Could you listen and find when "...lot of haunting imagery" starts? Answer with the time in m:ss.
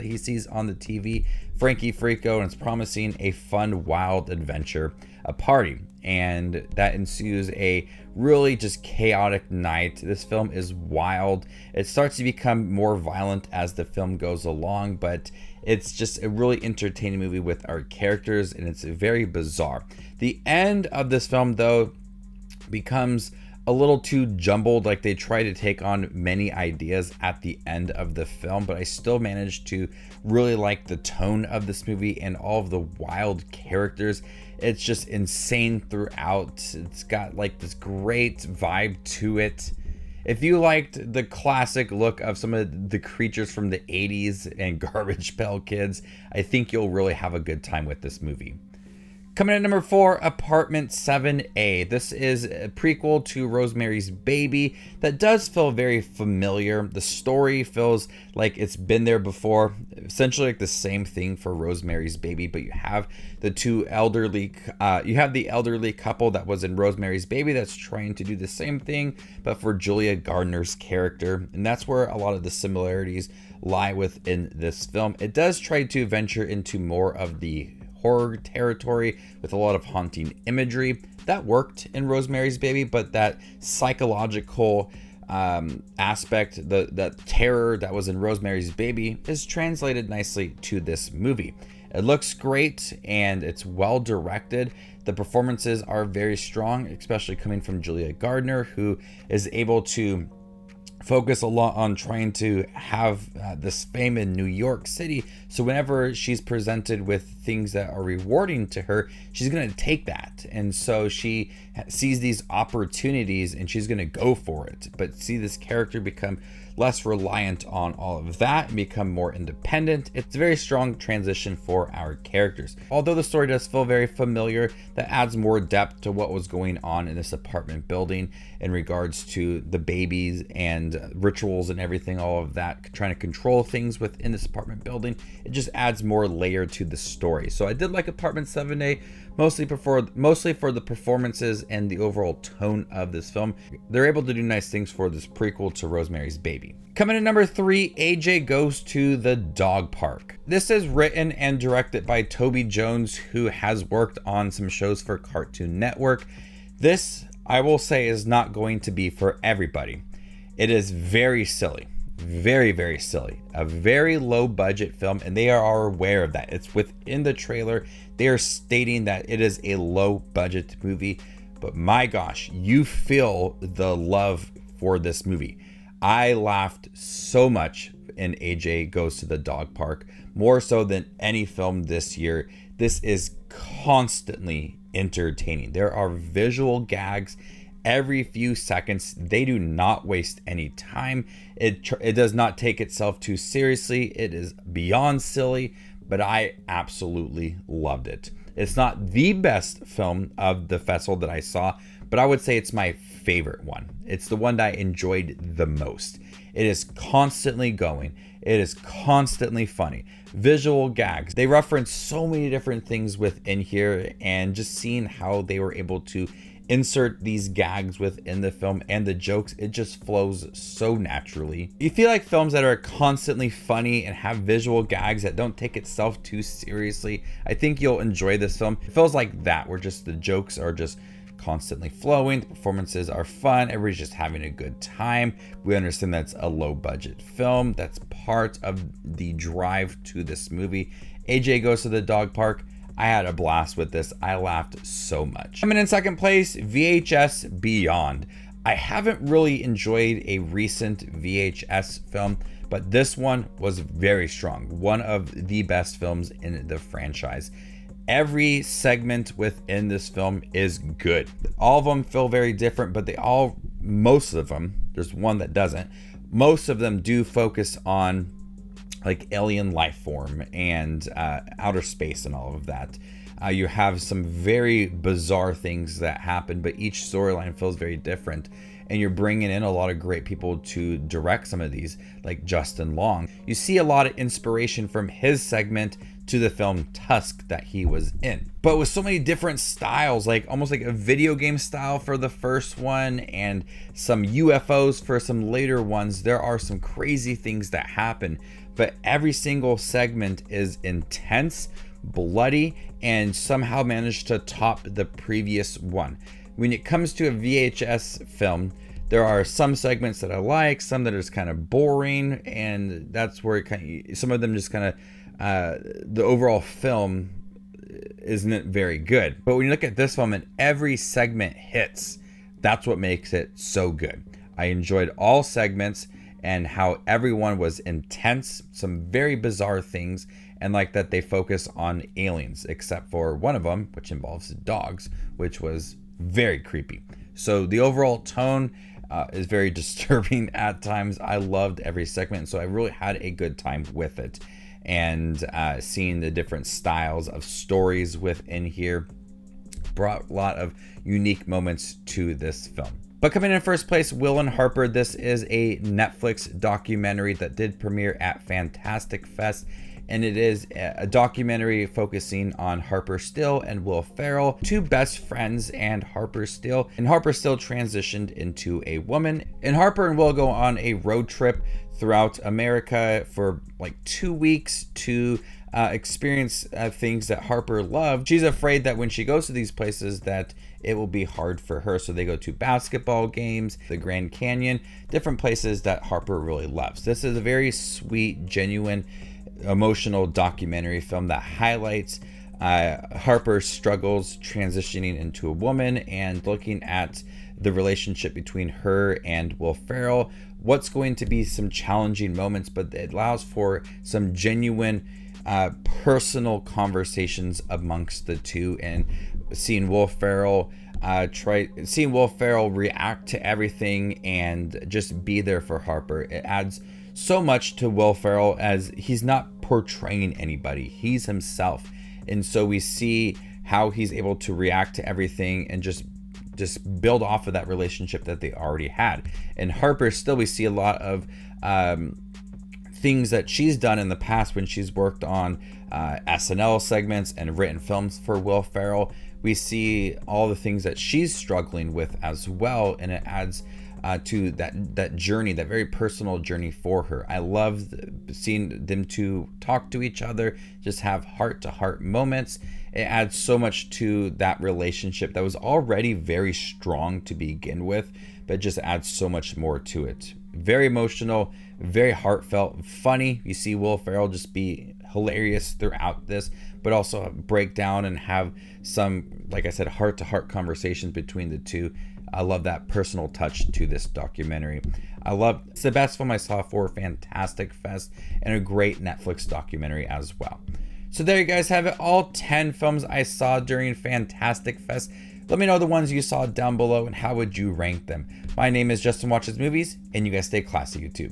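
1:19.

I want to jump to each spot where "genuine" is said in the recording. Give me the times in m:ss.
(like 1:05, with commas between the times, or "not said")
6:28, 6:44.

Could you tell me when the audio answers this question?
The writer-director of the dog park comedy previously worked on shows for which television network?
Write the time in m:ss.
2:35.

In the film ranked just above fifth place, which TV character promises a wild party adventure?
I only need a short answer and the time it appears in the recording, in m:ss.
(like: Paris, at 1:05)
Frankie Freako, at 0:01.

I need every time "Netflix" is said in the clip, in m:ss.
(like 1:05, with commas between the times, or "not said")
5:55, 7:59.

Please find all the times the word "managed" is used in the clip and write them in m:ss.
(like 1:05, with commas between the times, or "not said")
0:29, 5:03.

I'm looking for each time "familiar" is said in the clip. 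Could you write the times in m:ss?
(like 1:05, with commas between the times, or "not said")
0:56, 2:04.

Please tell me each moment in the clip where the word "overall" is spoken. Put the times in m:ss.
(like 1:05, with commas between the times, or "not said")
2:21, 5:16, 5:37.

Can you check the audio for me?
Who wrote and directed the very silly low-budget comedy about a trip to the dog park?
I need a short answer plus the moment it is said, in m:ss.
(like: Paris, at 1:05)
Toby Jones, at 2:32.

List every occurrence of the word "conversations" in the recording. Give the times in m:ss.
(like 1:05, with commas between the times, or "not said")
6:46, 7:50.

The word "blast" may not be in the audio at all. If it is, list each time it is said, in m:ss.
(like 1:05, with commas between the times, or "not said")
4:03.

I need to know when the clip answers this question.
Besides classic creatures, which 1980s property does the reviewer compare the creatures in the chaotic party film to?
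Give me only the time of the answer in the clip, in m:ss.
0:44.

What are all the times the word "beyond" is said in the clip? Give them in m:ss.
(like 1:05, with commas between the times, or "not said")
3:14, 4:07.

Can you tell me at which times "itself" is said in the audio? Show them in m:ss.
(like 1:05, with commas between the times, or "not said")
3:12, 3:45.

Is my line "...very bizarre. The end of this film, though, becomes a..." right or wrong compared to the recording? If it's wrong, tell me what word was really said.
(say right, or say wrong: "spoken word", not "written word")
right.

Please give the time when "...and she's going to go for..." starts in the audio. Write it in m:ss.
1:53.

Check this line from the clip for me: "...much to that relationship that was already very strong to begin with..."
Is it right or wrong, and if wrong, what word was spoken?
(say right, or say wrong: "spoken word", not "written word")
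right.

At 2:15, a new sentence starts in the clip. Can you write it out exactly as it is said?
It just adds more layer to the story.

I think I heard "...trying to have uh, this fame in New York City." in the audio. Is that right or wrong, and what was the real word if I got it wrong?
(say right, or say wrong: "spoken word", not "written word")
right.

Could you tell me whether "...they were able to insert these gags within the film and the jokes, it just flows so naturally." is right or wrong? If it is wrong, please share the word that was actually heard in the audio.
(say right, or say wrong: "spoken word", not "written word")
right.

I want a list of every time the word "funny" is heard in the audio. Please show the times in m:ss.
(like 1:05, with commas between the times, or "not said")
3:29, 3:43, 7:42.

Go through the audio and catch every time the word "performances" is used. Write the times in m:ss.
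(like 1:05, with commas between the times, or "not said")
1:35, 2:20, 3:52.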